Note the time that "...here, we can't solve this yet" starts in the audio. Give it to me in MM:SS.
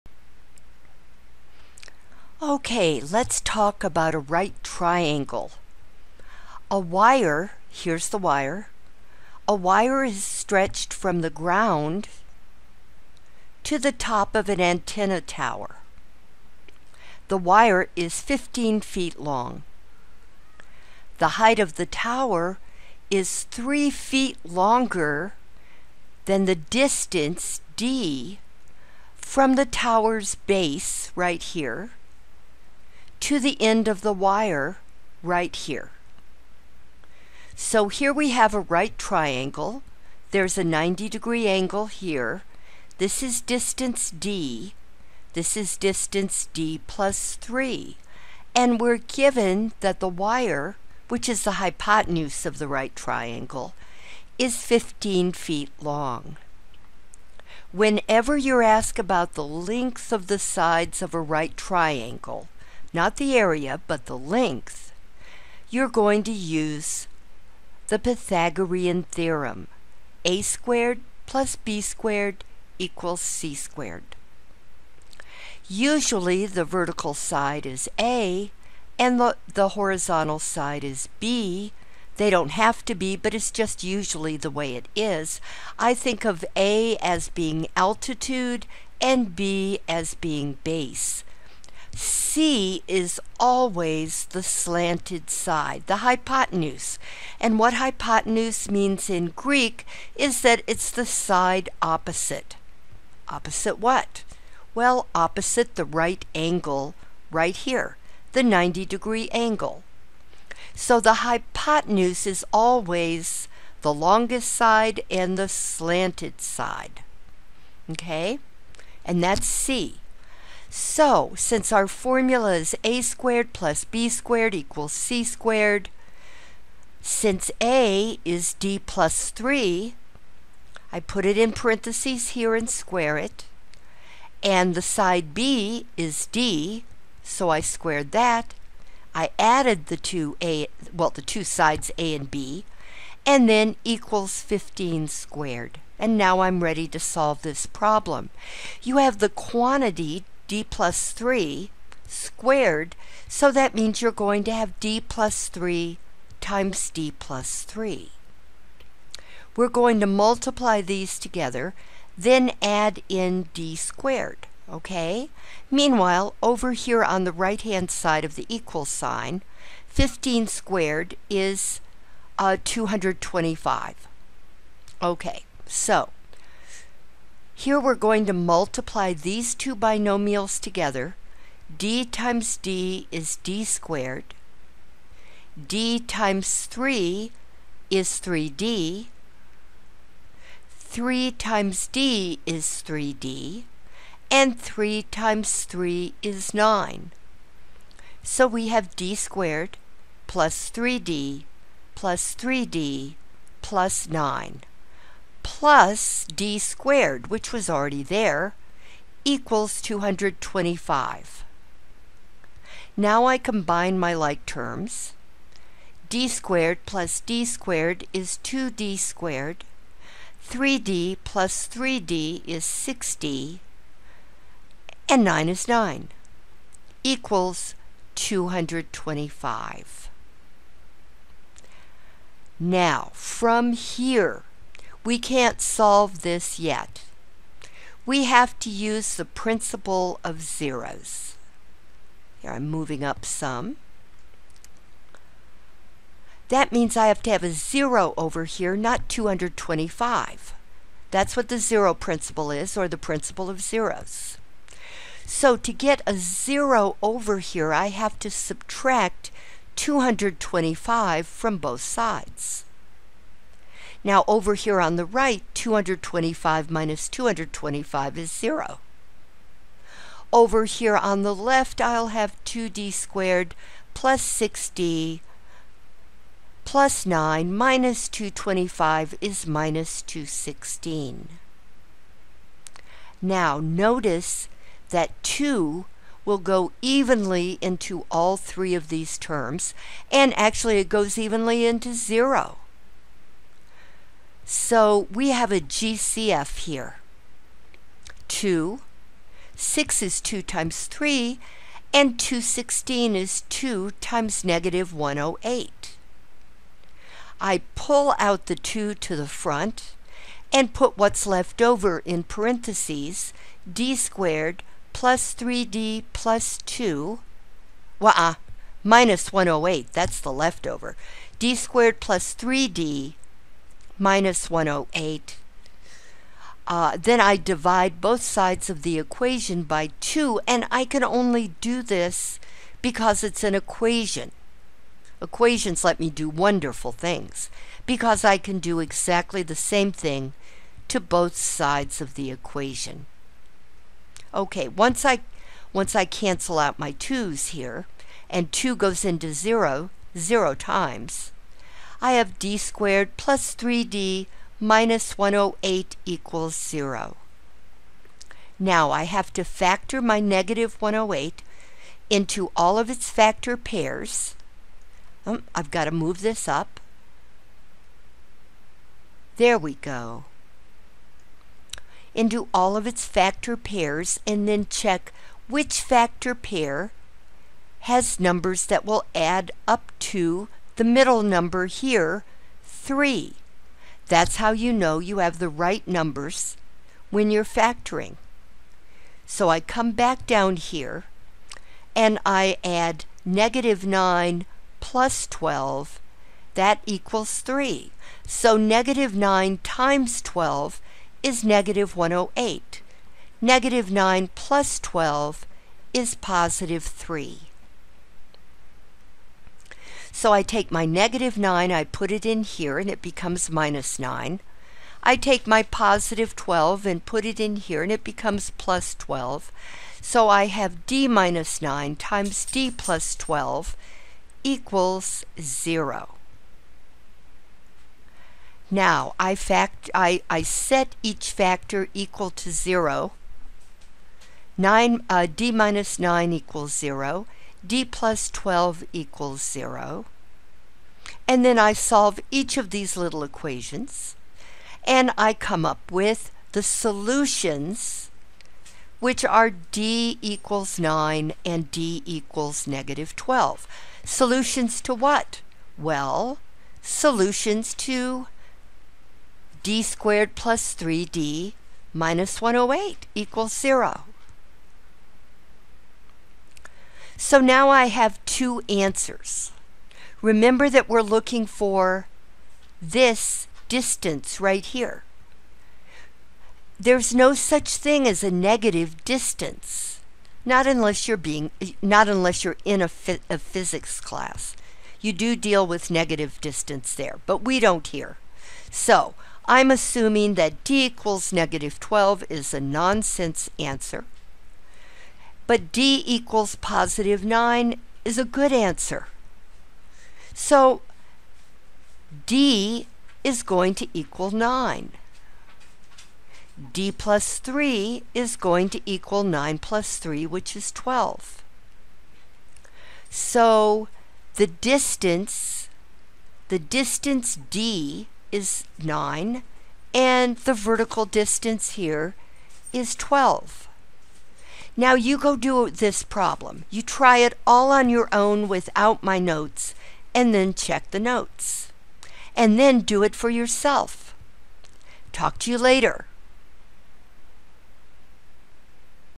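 03:53.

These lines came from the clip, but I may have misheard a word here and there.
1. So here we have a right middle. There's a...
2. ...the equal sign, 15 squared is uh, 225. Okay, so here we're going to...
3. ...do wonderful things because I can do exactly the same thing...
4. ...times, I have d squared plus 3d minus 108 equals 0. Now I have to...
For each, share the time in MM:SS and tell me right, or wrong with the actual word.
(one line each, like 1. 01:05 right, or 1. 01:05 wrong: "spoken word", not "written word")
1. 00:37 wrong: "triangle", not "middle"
2. 02:48 right
3. 05:36 right
4. 05:50 right.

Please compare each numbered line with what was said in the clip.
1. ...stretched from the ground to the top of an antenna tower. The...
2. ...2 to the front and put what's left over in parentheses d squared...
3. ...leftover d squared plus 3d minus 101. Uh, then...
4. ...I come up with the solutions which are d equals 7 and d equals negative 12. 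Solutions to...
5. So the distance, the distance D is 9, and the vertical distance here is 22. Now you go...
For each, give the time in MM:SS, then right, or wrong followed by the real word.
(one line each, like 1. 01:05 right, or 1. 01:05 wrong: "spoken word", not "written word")
1. 00:10 right
2. 05:08 right
3. 05:20 wrong: "108", not "101"
4. 07:25 wrong: "9", not "7"
5. 08:33 wrong: "12", not "22".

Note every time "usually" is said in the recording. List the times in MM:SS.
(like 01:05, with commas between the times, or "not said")
01:15, 01:23.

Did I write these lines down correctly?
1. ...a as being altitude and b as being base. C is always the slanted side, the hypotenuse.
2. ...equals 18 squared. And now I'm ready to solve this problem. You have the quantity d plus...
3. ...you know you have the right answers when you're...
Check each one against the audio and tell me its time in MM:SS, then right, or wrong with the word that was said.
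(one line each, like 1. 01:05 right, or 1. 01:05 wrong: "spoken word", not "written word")
1. 01:26 right
2. 02:23 wrong: "15", not "18"
3. 06:24 wrong: "numbers", not "answers".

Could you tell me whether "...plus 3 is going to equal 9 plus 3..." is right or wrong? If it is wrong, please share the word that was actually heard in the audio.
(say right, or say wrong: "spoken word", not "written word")
right.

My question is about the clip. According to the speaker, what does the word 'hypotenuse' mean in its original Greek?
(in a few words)
the side opposite.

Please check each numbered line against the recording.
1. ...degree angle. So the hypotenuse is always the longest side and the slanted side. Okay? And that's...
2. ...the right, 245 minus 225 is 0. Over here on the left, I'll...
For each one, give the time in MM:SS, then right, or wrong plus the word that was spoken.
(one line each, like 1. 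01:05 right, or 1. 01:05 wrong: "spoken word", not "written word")
1. 01:48 right
2. 04:24 wrong: "225", not "245".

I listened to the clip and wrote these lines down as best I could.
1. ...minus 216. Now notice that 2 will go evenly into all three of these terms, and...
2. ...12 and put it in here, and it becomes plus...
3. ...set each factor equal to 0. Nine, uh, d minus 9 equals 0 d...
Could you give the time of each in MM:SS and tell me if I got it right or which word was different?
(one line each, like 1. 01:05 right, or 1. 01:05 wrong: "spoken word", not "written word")
1. 04:39 right
2. 06:56 right
3. 07:10 right.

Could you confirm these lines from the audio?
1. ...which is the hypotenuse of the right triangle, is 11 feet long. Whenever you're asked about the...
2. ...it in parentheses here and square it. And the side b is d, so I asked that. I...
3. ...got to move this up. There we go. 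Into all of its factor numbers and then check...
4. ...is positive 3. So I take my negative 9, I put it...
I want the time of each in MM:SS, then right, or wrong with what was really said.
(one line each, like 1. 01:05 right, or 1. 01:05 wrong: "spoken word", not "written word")
1. 00:51 wrong: "15", not "11"
2. 02:11 wrong: "squared", not "asked"
3. 06:05 wrong: "pairs", not "numbers"
4. 06:45 right.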